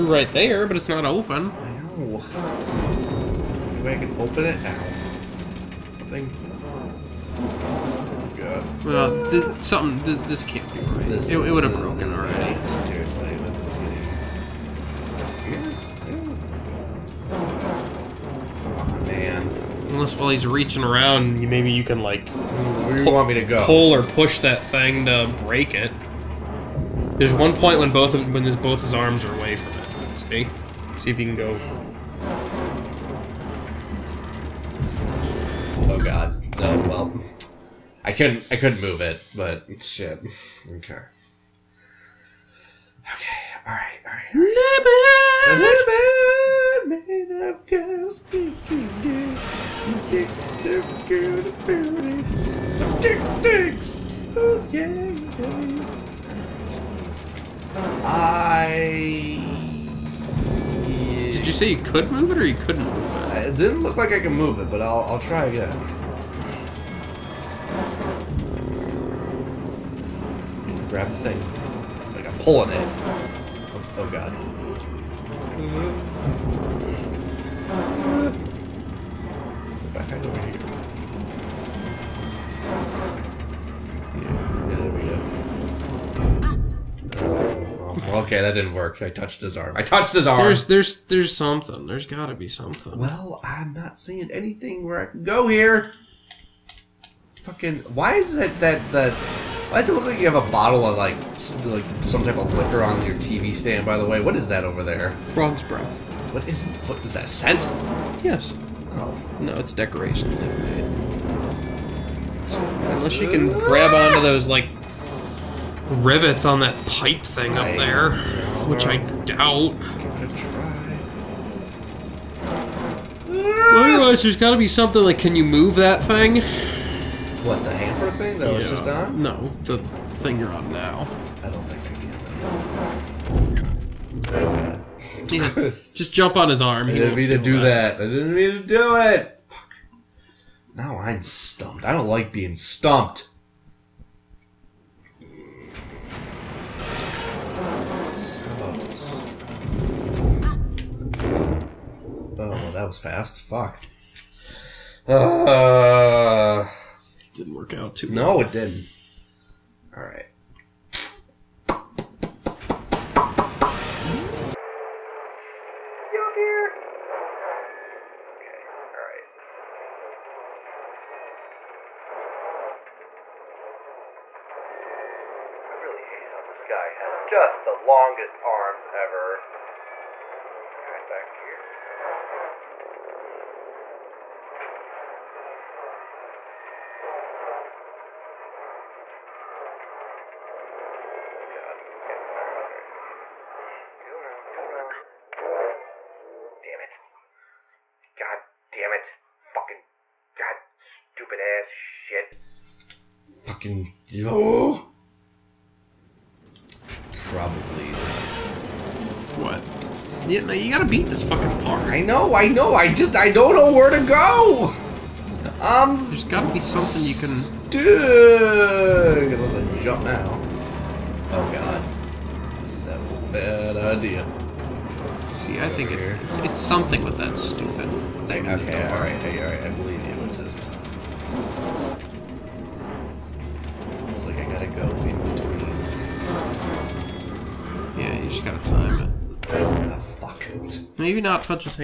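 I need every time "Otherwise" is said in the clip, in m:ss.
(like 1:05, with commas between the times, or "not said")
2:03.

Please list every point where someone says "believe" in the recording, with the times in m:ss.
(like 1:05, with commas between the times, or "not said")
3:49.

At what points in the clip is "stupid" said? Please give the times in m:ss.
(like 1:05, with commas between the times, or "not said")
3:20, 3:47.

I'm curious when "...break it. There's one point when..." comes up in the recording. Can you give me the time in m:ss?
0:25.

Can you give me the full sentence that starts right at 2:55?
I really hate how this guy has just the longest arms ever.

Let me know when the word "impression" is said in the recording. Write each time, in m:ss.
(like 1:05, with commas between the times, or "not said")
not said.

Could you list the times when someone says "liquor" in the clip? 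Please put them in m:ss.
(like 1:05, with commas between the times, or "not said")
1:42.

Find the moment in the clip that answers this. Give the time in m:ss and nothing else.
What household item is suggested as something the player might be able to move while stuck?
2:07.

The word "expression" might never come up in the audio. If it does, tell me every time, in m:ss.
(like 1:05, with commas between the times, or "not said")
not said.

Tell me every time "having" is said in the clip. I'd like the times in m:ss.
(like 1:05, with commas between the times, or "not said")
not said.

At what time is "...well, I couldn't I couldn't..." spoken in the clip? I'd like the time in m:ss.
0:36.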